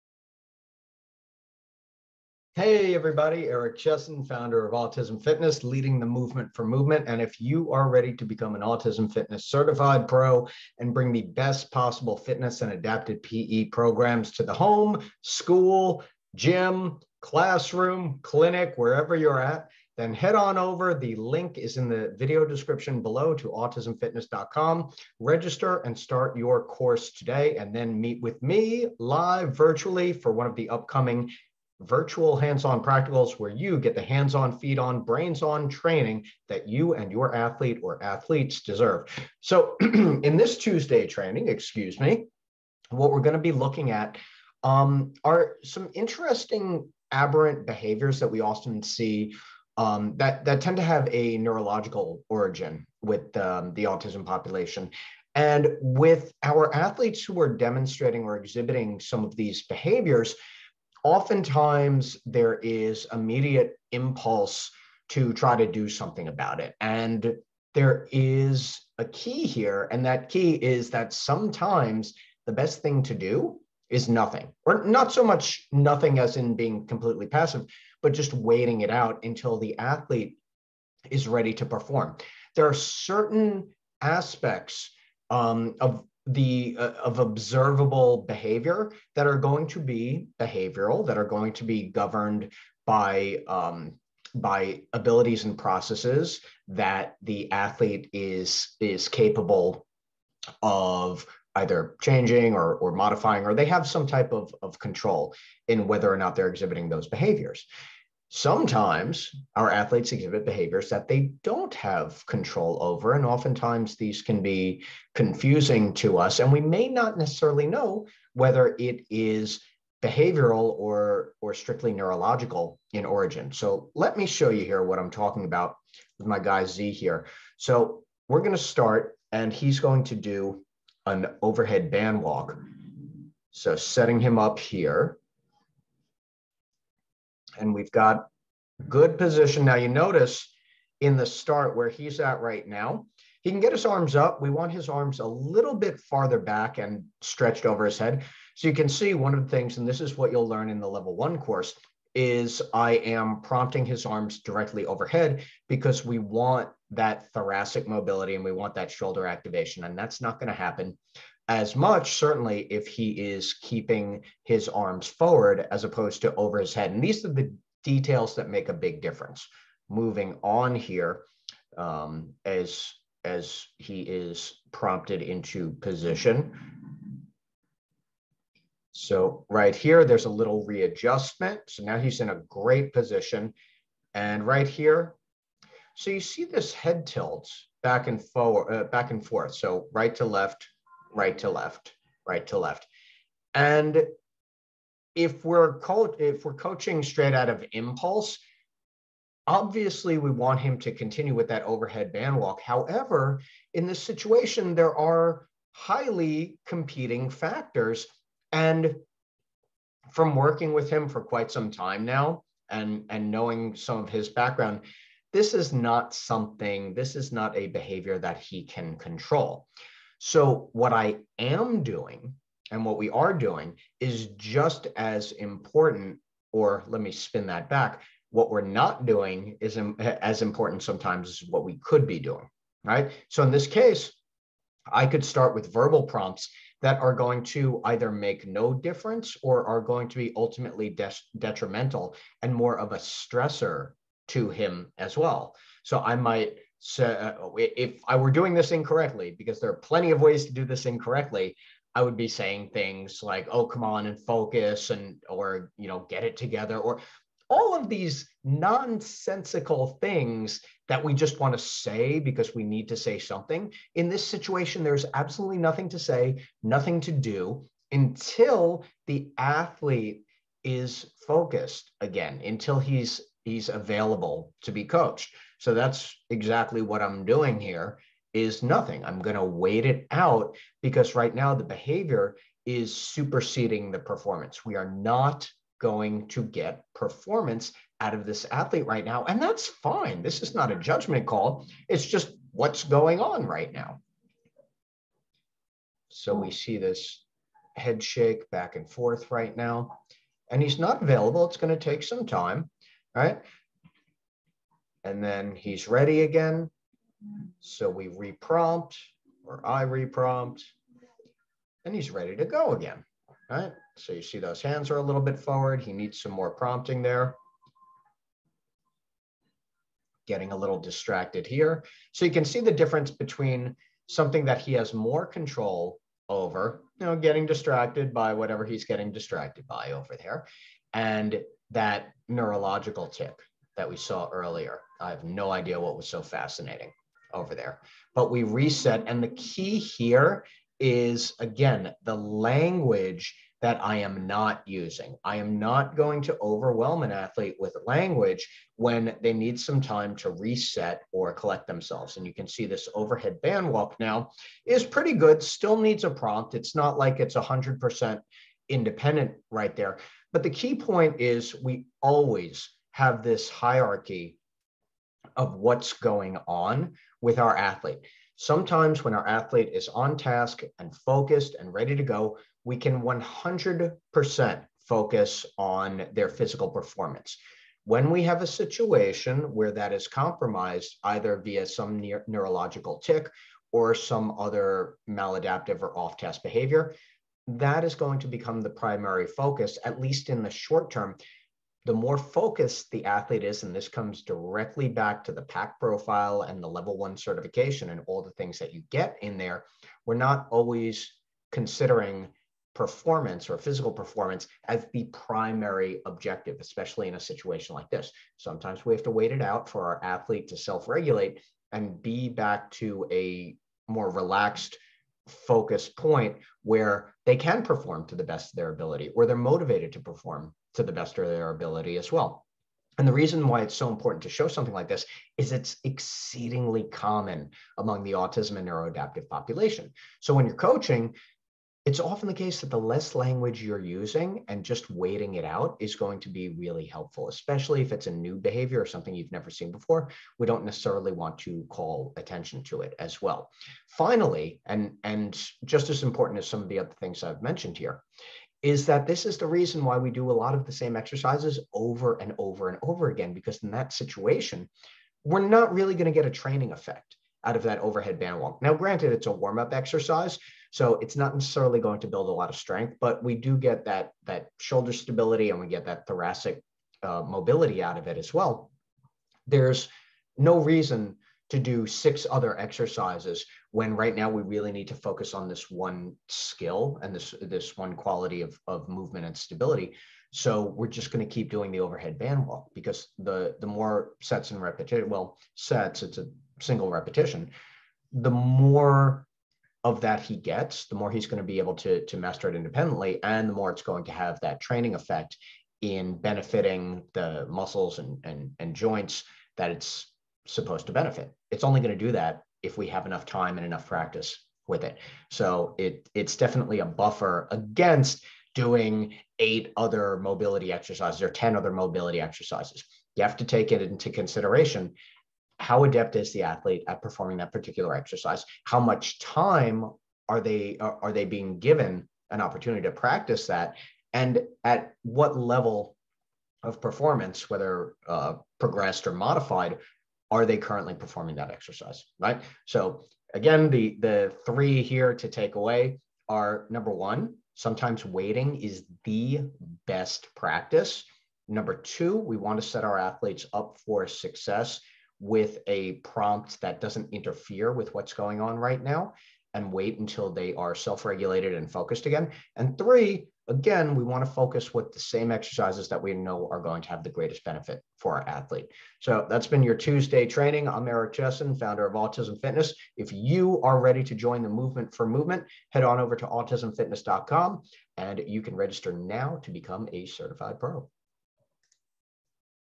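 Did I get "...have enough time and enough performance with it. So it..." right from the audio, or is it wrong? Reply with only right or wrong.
wrong.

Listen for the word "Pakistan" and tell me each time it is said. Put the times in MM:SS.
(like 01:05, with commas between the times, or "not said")
not said.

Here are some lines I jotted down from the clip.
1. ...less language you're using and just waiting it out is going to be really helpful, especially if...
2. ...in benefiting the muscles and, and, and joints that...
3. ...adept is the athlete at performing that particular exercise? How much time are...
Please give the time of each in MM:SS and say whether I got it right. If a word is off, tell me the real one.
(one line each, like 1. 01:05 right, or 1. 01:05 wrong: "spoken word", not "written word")
1. 07:12 right
2. 08:15 right
3. 08:35 right.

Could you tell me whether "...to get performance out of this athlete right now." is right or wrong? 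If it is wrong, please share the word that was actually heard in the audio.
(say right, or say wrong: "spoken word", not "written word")
right.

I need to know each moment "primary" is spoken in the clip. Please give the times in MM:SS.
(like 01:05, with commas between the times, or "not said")
06:28, 06:45.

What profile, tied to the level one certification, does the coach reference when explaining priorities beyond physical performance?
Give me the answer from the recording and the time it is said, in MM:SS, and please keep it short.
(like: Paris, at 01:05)
PAC profile, at 06:35.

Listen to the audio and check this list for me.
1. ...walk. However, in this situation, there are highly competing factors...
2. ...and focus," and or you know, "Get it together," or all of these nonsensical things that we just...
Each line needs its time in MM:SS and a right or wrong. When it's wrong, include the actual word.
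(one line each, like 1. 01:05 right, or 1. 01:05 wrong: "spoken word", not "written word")
1. 03:22 right
2. 04:14 right.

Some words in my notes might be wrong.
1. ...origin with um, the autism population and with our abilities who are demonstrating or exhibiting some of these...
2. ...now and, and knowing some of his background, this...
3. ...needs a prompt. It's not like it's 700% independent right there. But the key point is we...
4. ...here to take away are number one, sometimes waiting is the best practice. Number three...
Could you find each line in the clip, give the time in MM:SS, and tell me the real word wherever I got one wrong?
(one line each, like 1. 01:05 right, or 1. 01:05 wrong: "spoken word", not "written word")
1. 00:52 wrong: "athletes", not "abilities"
2. 03:32 right
3. 05:55 wrong: "100", not "700"
4. 08:54 wrong: "two", not "three".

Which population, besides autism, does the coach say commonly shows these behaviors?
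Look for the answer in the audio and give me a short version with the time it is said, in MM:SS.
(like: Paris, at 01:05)
neuroadaptive, at 07:08.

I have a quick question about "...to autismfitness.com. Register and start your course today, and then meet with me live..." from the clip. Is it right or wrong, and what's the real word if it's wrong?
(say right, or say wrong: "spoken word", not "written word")
right.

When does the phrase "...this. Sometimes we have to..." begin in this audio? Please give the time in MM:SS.
06:47.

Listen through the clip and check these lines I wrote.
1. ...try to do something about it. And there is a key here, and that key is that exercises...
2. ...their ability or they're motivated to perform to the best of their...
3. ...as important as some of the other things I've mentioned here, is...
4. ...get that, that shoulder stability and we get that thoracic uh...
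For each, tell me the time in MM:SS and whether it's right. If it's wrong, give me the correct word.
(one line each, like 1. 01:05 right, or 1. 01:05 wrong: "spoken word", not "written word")
1. 01:05 wrong: "sometimes", not "exercises"
2. 06:58 right
3. 07:25 right
4. 07:43 right.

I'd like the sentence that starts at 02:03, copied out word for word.
So let me show you here what I'm talking about with my guy Z here.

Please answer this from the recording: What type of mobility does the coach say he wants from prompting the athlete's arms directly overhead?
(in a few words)
thoracic mobility.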